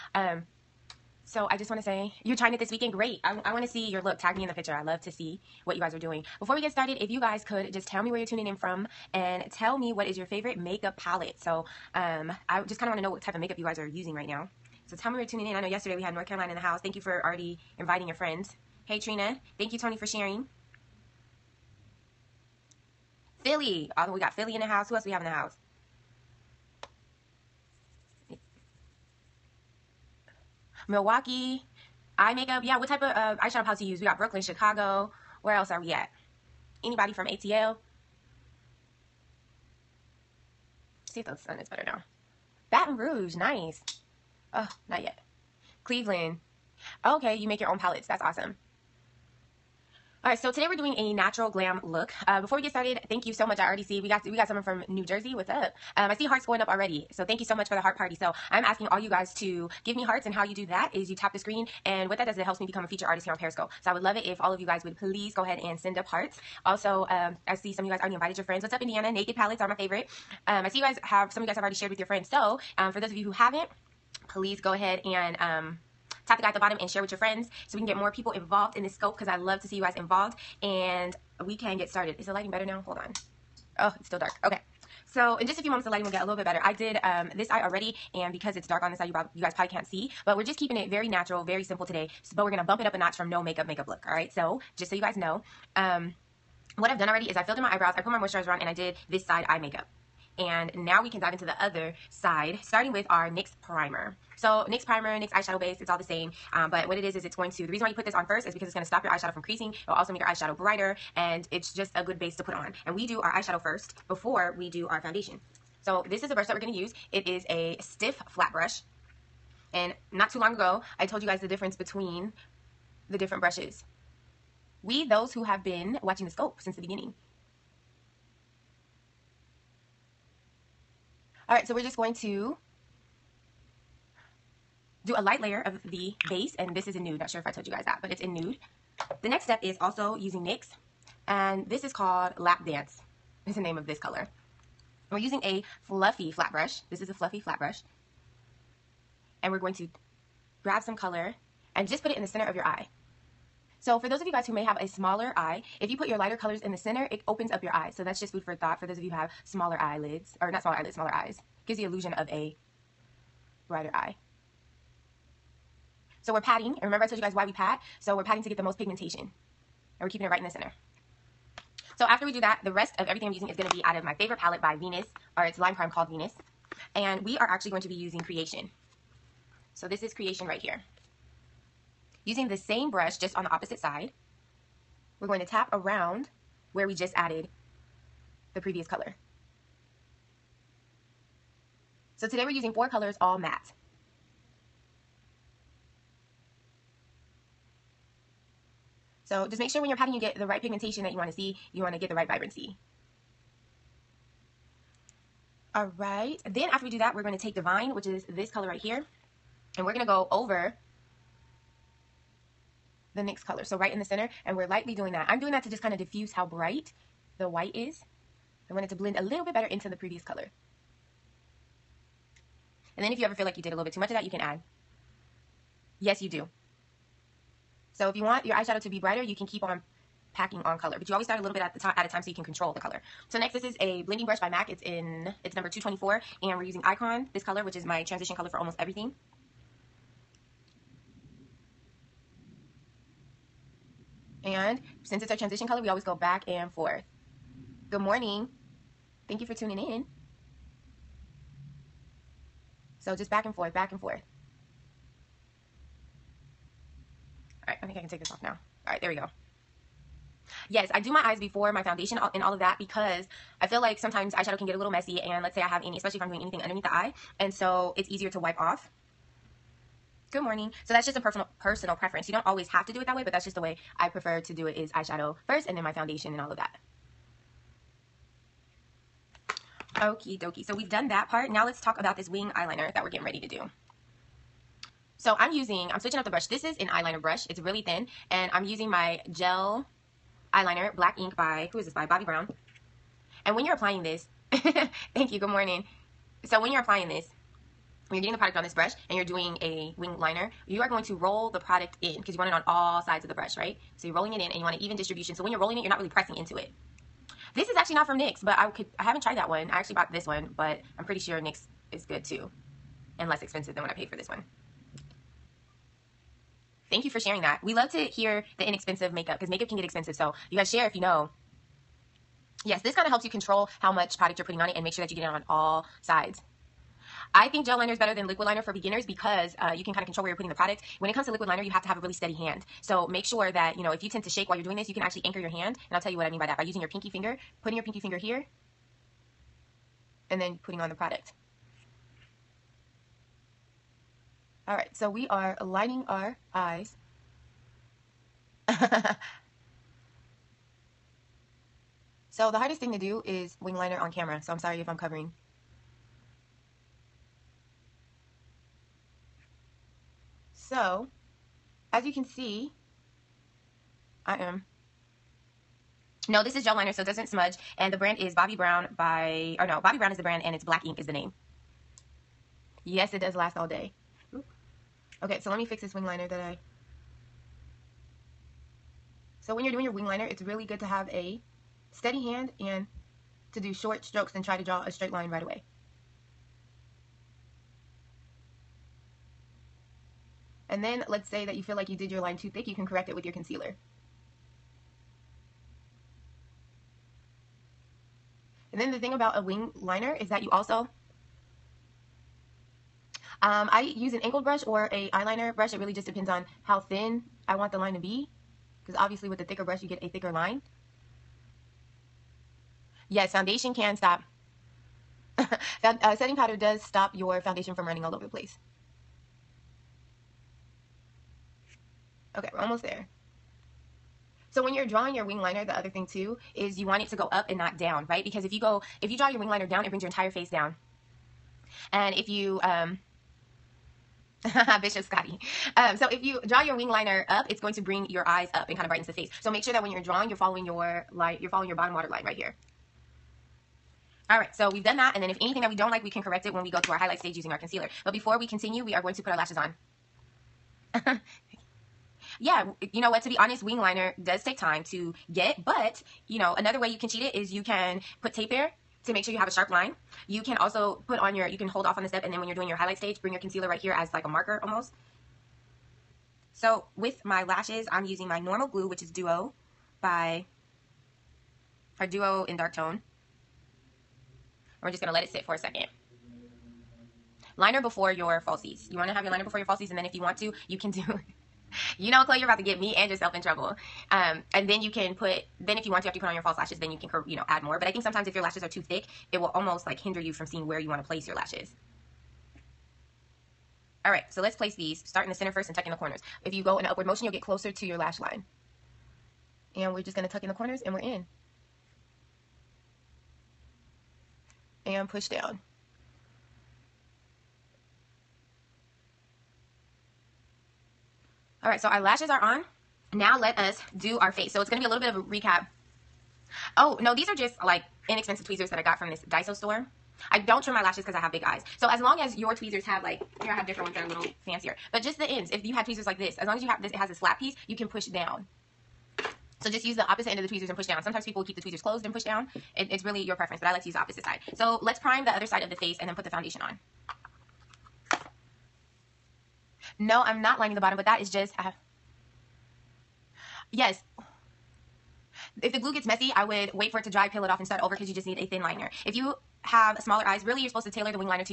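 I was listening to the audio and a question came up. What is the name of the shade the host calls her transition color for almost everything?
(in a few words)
Icon.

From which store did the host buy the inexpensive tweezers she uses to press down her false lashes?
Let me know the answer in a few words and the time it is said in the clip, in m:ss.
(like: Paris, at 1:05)
Daiso, at 8:39.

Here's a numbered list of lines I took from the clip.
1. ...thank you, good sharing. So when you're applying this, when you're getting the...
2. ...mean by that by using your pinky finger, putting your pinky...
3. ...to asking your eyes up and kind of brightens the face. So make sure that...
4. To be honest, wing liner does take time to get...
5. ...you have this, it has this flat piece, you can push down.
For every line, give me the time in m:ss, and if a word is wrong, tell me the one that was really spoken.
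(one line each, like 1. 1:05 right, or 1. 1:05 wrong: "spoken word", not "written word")
1. 4:55 wrong: "morning", not "sharing"
2. 5:36 right
3. 7:17 wrong: "bring", not "asking"
4. 7:33 right
5. 8:46 right.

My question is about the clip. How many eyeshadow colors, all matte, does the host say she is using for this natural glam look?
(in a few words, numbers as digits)
4.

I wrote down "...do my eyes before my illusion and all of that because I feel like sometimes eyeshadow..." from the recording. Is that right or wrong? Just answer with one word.
wrong.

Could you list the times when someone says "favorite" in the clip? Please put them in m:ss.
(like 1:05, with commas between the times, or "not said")
0:10, 1:09, 2:54.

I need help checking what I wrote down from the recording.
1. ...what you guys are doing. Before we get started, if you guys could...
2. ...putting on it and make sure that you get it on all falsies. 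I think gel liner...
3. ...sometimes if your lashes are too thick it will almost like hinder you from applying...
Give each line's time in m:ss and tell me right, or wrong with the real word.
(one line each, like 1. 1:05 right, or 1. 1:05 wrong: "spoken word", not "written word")
1. 0:05 right
2. 5:24 wrong: "sides", not "falsies"
3. 8:08 wrong: "seeing", not "applying".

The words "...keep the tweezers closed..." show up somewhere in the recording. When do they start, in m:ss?
8:51.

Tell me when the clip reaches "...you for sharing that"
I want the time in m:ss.
5:17.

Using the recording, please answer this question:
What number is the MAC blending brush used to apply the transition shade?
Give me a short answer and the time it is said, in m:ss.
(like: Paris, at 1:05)
224, at 3:55.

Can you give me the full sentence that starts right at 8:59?
No, I'm not lining the bottom, but that is just, I have, yes.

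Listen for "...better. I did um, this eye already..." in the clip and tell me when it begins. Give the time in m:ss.
1:26.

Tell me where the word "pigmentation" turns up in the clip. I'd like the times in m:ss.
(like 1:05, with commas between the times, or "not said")
2:48, 3:20.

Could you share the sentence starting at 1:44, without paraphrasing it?
So NYX primer, NYX eyeshadow base, it's all the same.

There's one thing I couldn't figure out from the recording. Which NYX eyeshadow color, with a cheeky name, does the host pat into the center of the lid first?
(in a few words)
Lap Dance.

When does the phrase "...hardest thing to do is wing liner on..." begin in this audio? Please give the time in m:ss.
5:52.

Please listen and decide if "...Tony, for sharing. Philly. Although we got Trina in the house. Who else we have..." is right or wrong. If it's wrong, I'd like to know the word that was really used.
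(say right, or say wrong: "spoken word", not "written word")
wrong: "Philly", not "Trina".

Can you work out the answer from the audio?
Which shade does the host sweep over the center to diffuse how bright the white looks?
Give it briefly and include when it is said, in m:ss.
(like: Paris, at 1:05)
Divine, at 3:27.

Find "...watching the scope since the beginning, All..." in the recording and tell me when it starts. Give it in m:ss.
2:06.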